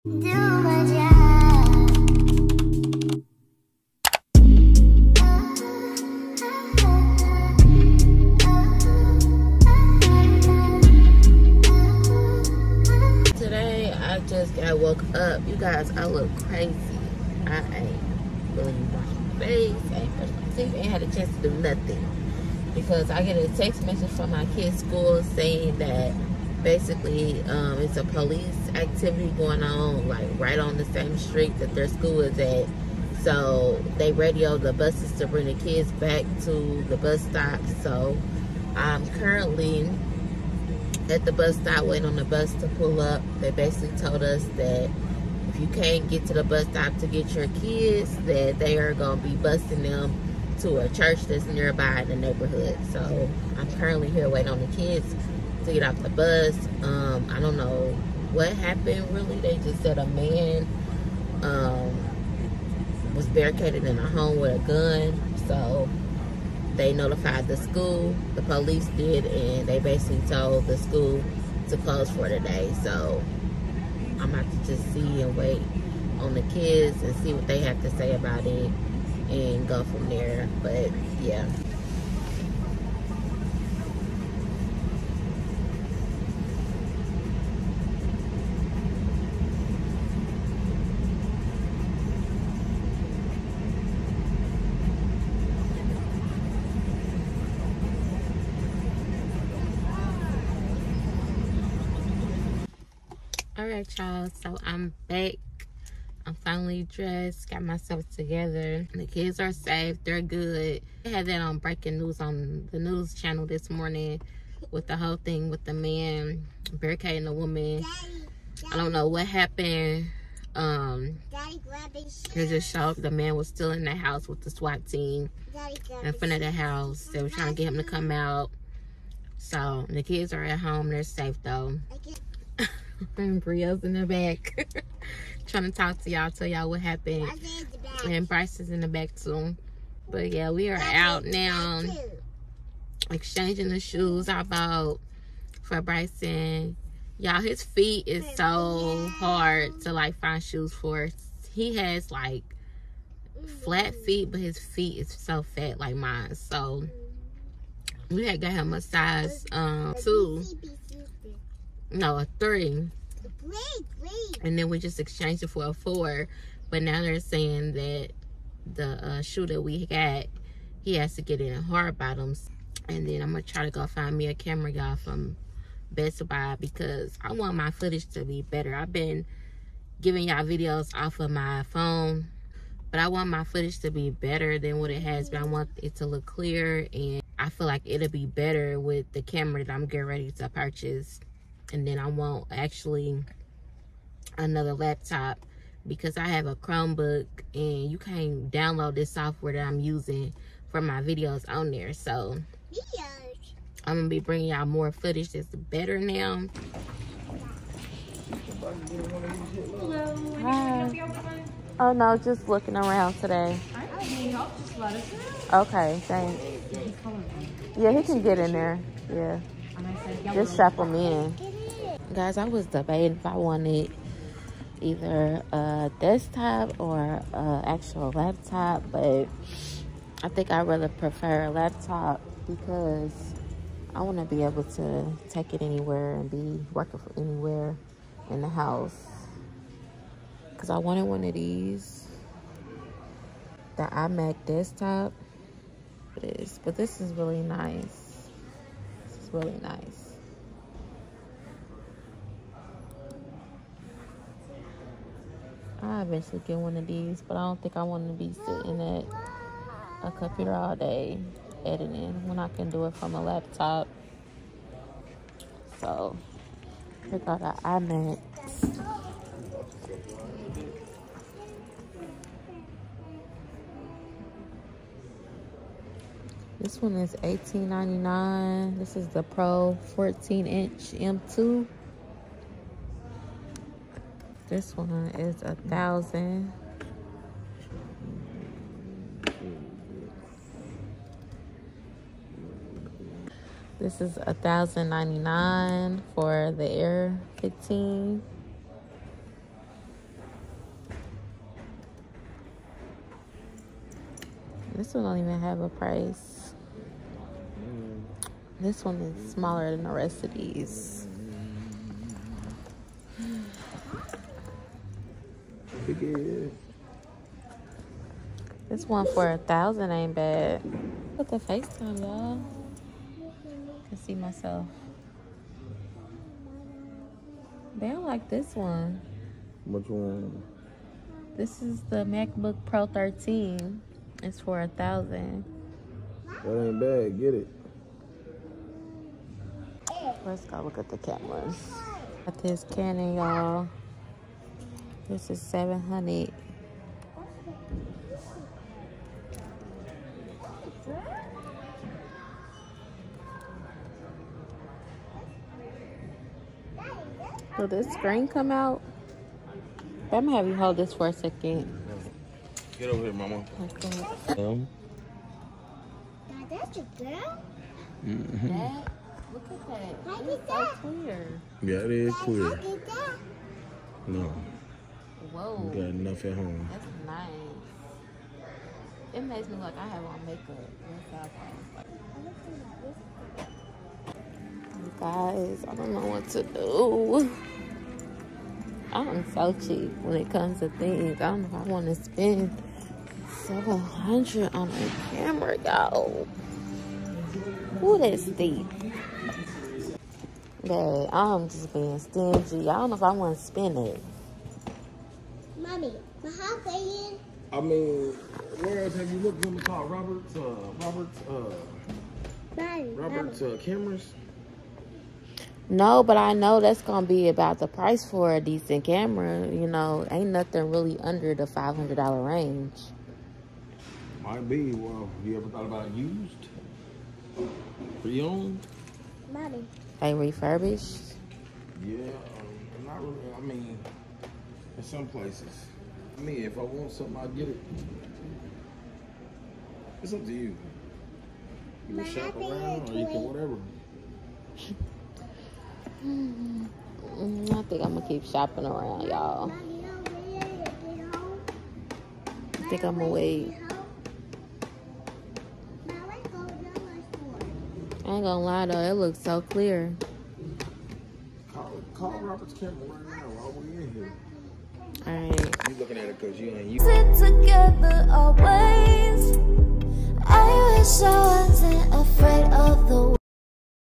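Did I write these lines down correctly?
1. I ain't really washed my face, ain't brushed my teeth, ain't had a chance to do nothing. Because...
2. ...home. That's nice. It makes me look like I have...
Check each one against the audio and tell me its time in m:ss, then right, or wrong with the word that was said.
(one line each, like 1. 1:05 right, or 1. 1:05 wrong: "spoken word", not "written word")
1. 0:17 right
2. 6:16 right.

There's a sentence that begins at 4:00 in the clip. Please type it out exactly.
Because I wanted one of these, the iMac desktop, but, but this is really nice.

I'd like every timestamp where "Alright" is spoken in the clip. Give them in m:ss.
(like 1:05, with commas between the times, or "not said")
1:43, 7:45.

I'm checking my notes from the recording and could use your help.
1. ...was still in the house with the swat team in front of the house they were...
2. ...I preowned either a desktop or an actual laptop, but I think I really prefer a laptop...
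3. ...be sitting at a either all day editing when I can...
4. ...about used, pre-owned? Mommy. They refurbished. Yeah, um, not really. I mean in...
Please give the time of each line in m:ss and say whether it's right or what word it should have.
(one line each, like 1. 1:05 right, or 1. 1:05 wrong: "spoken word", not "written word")
1. 2:03 right
2. 3:43 wrong: "wanted", not "preowned"
3. 4:18 wrong: "computer", not "either"
4. 7:05 right.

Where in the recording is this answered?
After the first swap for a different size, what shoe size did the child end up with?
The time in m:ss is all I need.
2:45.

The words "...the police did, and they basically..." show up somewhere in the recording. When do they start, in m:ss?
1:08.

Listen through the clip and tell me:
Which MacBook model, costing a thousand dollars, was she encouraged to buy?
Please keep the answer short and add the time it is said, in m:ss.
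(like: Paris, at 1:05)
MacBook Pro 13, at 5:32.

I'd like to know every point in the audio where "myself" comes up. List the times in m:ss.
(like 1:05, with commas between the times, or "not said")
1:47, 5:24.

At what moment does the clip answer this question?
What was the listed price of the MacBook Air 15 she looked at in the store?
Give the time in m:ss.
4:54.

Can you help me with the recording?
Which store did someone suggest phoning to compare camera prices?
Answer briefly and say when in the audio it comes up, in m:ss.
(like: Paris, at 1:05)
Robert's Camera, at 7:42.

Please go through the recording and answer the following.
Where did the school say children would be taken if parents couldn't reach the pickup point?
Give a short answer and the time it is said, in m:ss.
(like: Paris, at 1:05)
a church, at 0:50.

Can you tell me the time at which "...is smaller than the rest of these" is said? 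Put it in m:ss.
5:08.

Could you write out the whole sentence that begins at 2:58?
I've been giving y'all videos off of my phone, but I want my footage to be better than what it has been.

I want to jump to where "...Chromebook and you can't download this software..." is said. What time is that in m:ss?
3:16.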